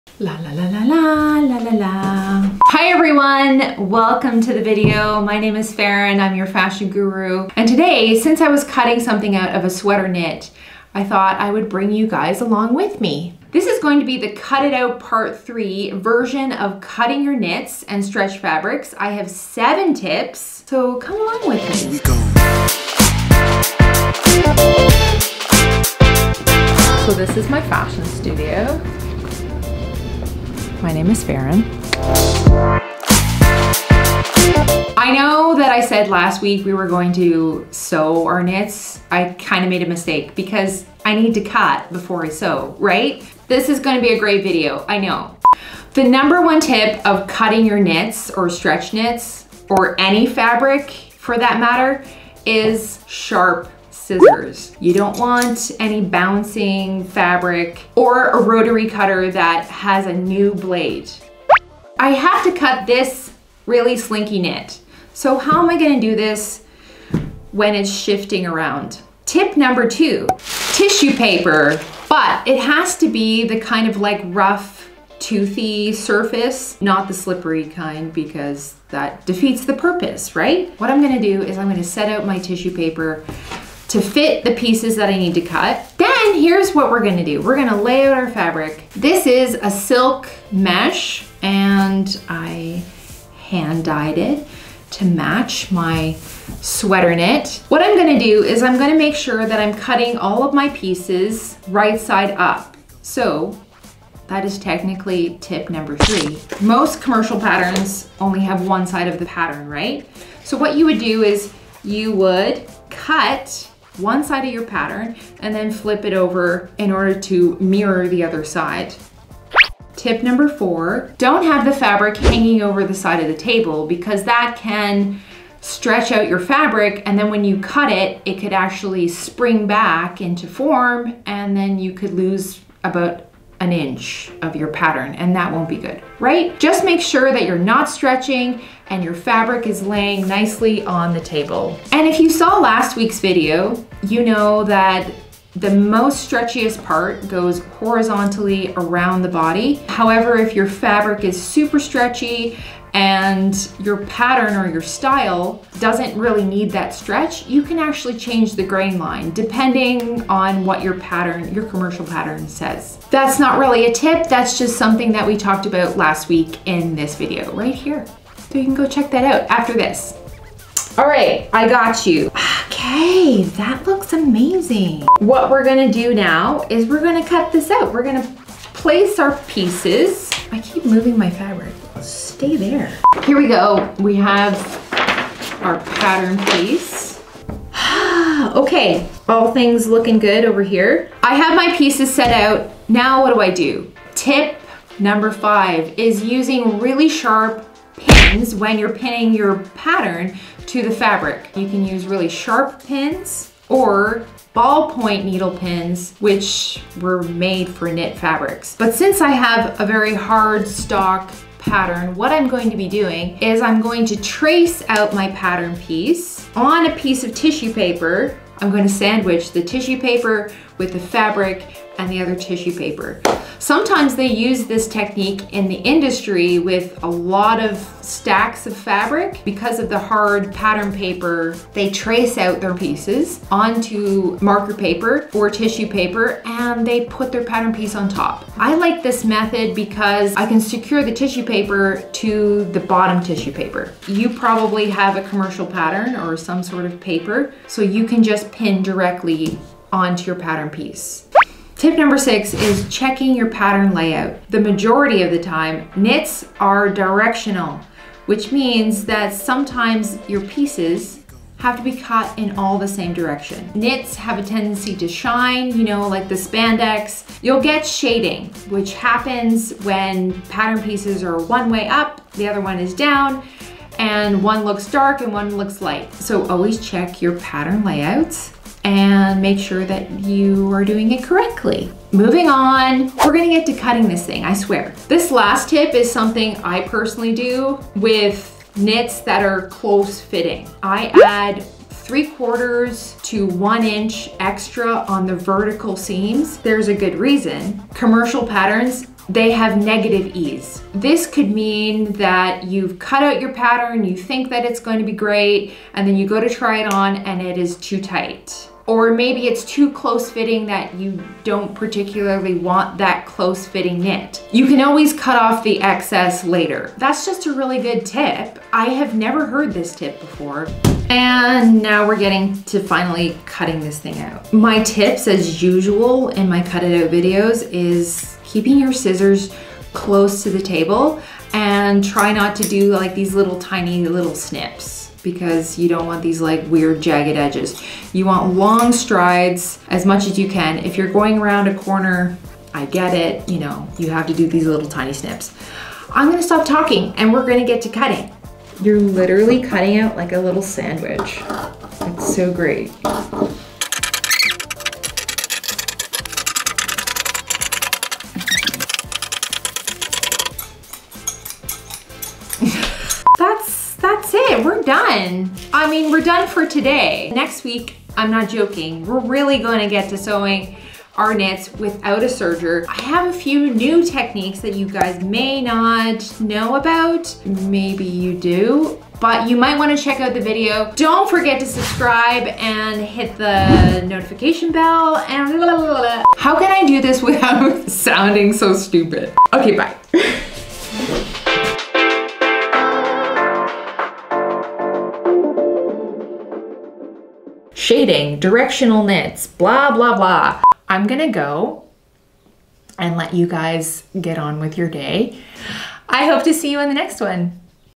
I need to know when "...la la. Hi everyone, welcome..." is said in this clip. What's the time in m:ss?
0:01.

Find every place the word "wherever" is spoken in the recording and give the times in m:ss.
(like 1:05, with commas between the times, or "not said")
not said.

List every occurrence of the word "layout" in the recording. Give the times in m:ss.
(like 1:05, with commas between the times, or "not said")
4:13, 4:37.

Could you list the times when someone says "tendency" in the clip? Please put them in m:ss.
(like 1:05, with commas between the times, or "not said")
4:24.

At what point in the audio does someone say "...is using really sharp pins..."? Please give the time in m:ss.
3:15.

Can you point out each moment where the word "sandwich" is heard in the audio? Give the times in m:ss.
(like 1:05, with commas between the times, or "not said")
3:38, 5:50.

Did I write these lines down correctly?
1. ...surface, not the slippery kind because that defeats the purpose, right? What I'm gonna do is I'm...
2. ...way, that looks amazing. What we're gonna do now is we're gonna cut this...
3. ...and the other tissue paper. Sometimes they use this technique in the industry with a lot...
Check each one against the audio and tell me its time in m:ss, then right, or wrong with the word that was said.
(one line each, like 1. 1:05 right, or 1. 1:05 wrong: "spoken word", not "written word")
1. 1:15 right
2. 2:53 right
3. 3:42 right.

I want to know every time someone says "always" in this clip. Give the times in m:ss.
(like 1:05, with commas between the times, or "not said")
4:36, 5:14.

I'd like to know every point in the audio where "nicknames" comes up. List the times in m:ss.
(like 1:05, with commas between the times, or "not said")
not said.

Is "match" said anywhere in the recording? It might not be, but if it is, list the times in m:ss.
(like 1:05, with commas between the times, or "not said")
1:35.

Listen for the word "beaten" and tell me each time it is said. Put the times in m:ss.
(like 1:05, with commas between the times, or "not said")
not said.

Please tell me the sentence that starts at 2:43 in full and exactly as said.
That's not really a tip, that's just something that we talked about last week in this video right here.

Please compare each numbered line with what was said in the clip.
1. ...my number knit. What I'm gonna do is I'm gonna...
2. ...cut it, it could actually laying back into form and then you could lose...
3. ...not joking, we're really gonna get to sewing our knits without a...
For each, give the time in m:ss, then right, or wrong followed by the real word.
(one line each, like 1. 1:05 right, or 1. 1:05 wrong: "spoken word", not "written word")
1. 1:35 wrong: "sweater", not "number"
2. 2:07 wrong: "spring", not "laying"
3. 6:08 right.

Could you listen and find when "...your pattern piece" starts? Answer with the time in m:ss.
4:10.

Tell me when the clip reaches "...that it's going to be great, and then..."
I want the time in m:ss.
5:04.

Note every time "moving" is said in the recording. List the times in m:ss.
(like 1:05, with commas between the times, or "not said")
3:00, 4:42.